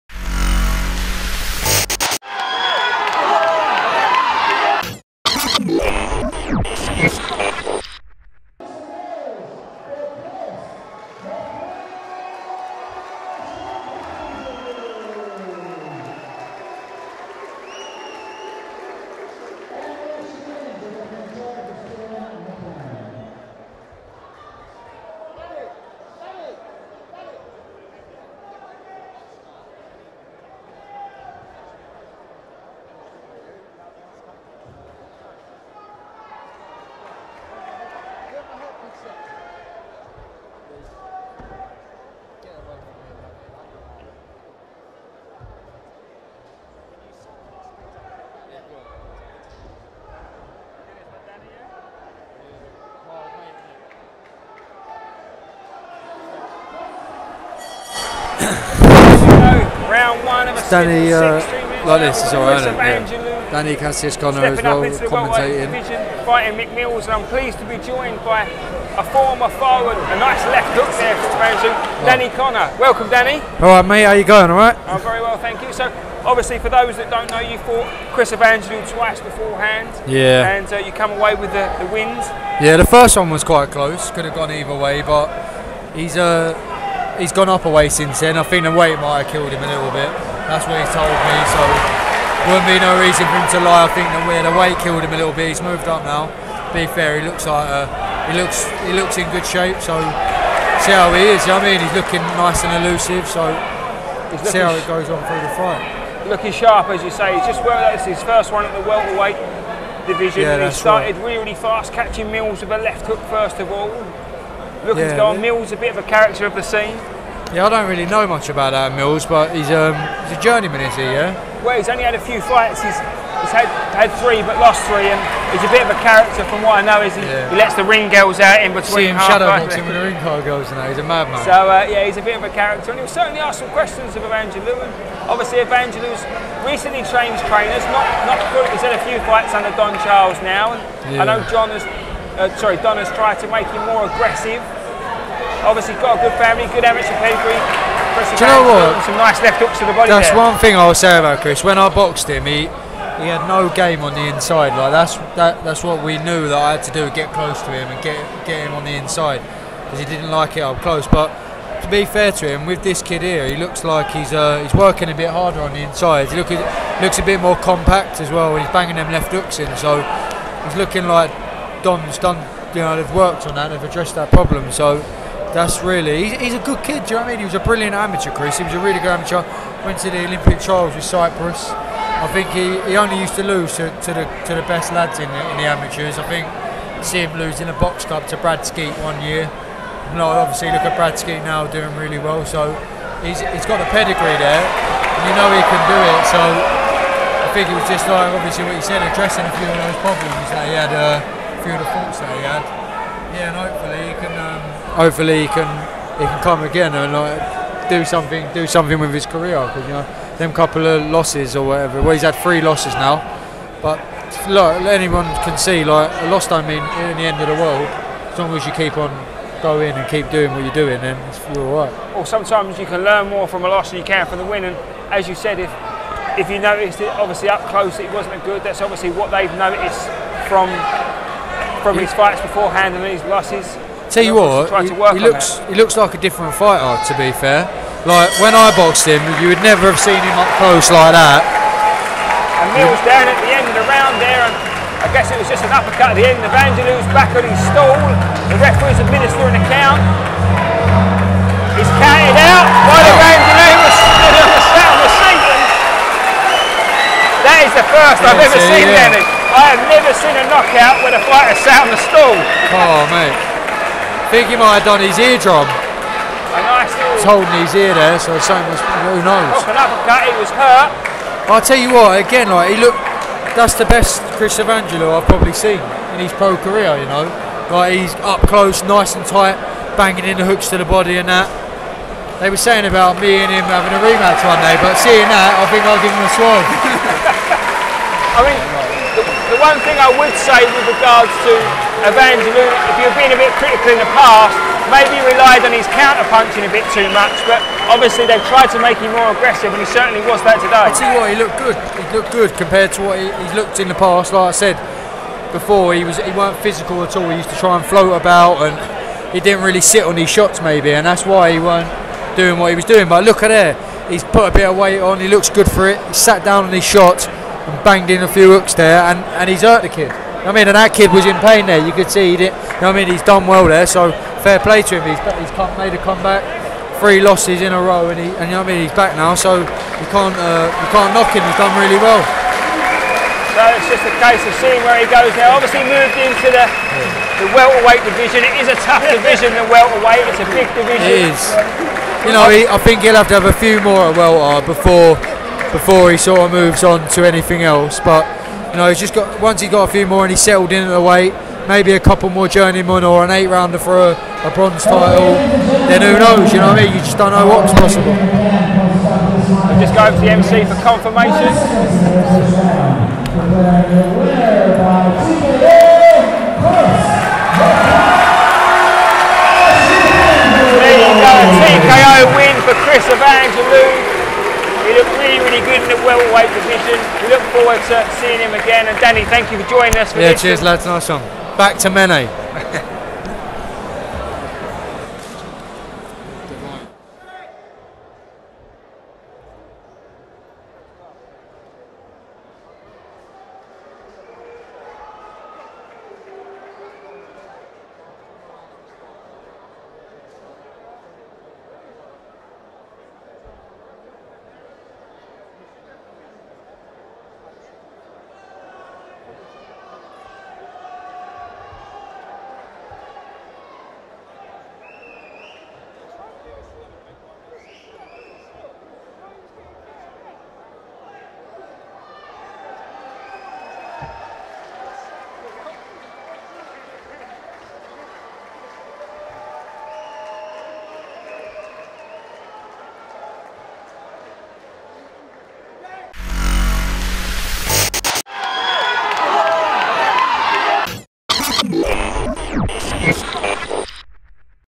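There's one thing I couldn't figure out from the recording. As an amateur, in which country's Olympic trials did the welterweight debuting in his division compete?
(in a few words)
Cyprus.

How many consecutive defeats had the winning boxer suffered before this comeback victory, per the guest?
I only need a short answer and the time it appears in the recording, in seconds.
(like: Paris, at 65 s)
3, at 326 s.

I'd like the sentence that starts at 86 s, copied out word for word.
Uh, he's gone up a way since then.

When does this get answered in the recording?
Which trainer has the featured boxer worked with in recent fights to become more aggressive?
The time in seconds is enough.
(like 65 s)
139 s.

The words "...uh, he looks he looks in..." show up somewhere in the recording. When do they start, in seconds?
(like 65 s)
97 s.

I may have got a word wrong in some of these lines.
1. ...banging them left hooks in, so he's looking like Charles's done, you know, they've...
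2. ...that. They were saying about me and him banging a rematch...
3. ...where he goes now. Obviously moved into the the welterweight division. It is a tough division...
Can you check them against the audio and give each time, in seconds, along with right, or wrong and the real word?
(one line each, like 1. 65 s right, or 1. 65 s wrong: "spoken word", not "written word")
1. 168 s wrong: "Don", not "Charles"
2. 281 s wrong: "having", not "banging"
3. 334 s right.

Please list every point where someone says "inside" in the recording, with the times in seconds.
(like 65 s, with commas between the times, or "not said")
154 s, 158 s, 165 s.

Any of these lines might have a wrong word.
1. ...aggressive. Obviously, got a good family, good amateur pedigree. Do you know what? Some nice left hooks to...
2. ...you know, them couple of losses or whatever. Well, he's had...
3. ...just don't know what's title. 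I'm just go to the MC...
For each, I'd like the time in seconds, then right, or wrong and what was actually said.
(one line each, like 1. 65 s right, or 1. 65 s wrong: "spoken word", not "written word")
1. 144 s right
2. 209 s right
3. 356 s wrong: "possible", not "title".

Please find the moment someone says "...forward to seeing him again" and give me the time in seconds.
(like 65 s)
377 s.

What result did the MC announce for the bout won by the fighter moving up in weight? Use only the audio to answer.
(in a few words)
TKO.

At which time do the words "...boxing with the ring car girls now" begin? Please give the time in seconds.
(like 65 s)
129 s.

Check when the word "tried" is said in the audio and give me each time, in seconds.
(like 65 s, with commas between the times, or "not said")
143 s, 298 s.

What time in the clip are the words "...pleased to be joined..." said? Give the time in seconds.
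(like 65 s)
67 s.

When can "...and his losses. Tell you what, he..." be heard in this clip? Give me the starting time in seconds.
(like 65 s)
232 s.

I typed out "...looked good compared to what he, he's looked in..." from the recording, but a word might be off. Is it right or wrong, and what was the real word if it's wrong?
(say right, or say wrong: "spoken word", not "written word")
right.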